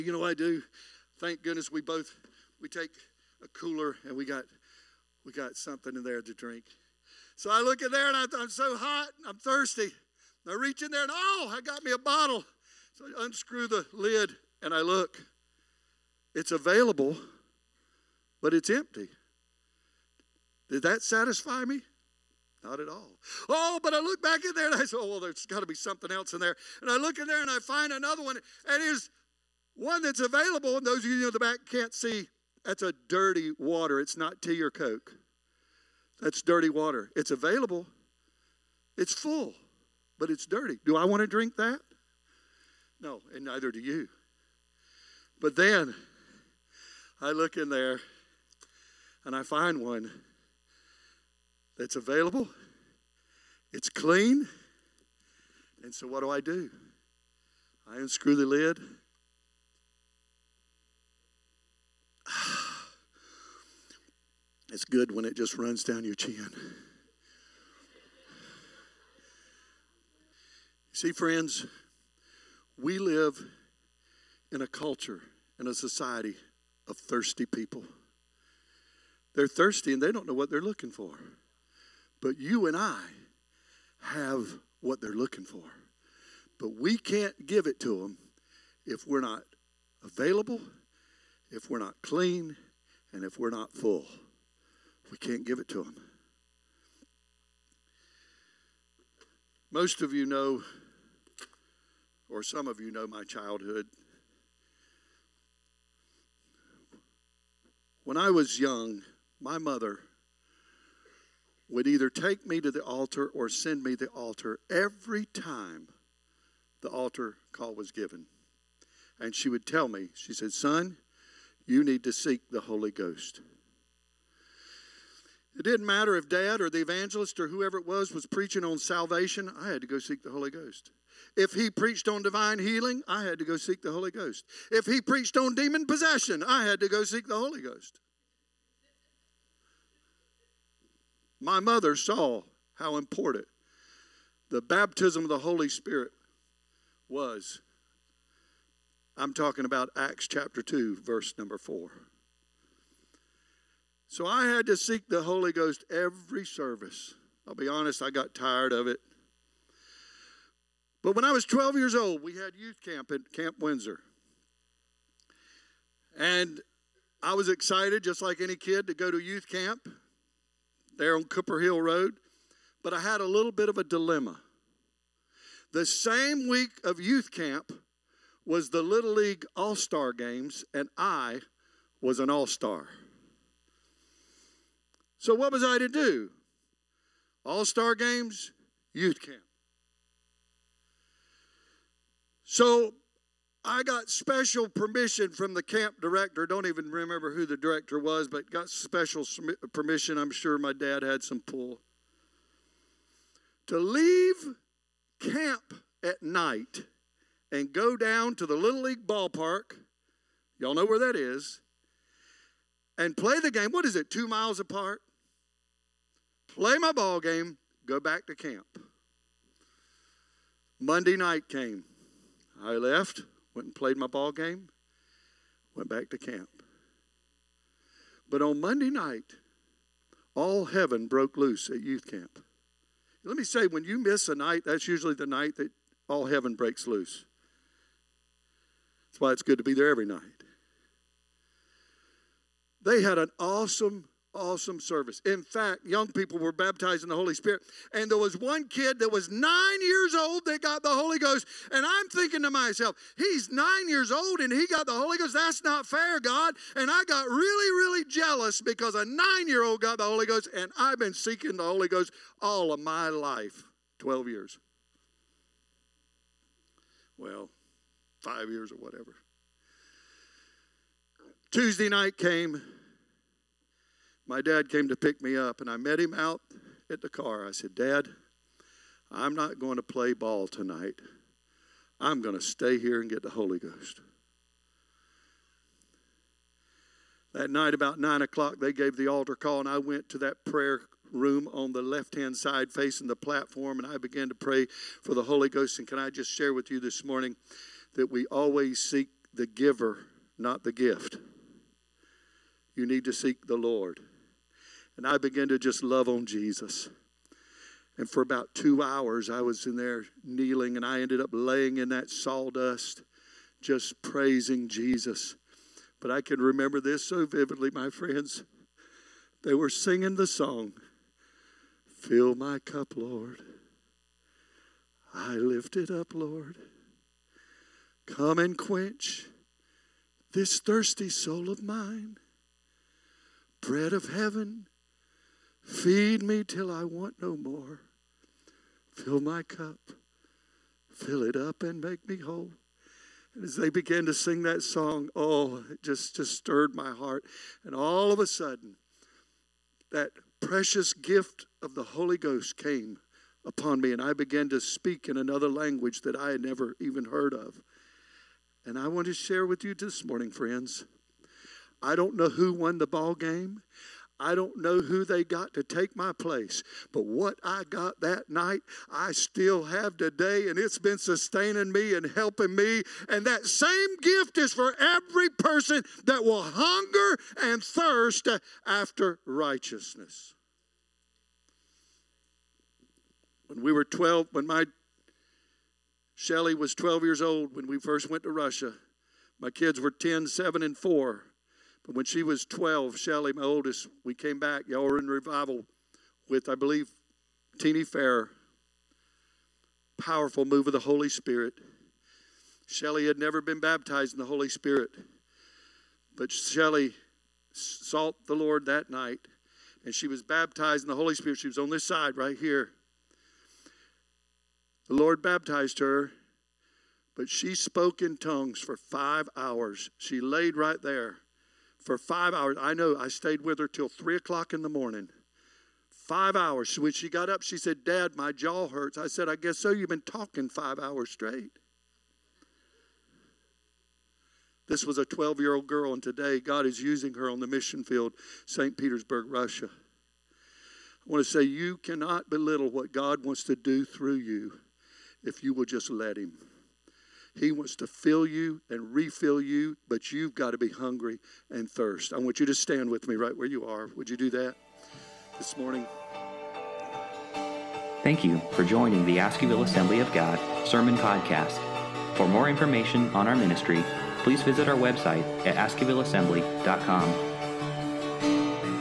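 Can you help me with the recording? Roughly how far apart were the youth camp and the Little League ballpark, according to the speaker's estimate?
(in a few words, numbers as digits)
2 miles.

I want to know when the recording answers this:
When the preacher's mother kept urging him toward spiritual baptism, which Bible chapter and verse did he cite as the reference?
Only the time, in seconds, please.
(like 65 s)
149 s.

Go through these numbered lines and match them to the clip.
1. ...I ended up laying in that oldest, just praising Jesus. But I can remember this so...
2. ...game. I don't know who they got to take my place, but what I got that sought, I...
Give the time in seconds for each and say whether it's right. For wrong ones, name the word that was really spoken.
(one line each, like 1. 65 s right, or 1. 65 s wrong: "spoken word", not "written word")
1. 310 s wrong: "sawdust", not "oldest"
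2. 363 s wrong: "night", not "sought".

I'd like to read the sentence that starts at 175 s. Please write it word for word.
The same week of youth camp was the Little League All Star Games, and I was an All Star.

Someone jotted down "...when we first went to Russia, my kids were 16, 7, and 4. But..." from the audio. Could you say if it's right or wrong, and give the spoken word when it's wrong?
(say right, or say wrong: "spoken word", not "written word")
wrong: "10", not "16".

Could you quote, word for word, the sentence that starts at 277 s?
I said, Dad, I'm not going to play ball tonight.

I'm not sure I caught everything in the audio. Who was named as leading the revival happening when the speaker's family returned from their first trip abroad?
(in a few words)
Teeny Fair.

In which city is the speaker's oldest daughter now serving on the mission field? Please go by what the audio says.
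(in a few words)
St. Petersburg.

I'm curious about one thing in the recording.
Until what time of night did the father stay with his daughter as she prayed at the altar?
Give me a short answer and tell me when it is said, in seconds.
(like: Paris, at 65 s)
3 o'clock, at 423 s.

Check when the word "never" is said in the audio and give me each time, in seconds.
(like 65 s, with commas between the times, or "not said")
356 s, 403 s.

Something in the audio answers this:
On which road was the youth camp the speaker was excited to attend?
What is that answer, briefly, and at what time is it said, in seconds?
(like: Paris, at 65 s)
Cooper Hill Road, at 171 s.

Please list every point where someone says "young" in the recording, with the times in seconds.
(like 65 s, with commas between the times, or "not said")
108 s, 245 s.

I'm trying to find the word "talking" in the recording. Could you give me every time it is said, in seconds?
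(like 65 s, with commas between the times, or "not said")
149 s, 430 s.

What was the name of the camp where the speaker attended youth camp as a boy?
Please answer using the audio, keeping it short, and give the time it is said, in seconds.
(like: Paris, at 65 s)
Camp Windsor, at 163 s.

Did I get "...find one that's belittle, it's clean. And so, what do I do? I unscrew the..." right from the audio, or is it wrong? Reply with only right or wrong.
wrong.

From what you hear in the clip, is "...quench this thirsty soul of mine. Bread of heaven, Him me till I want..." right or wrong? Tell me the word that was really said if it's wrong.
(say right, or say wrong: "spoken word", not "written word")
wrong: "Feed", not "Him".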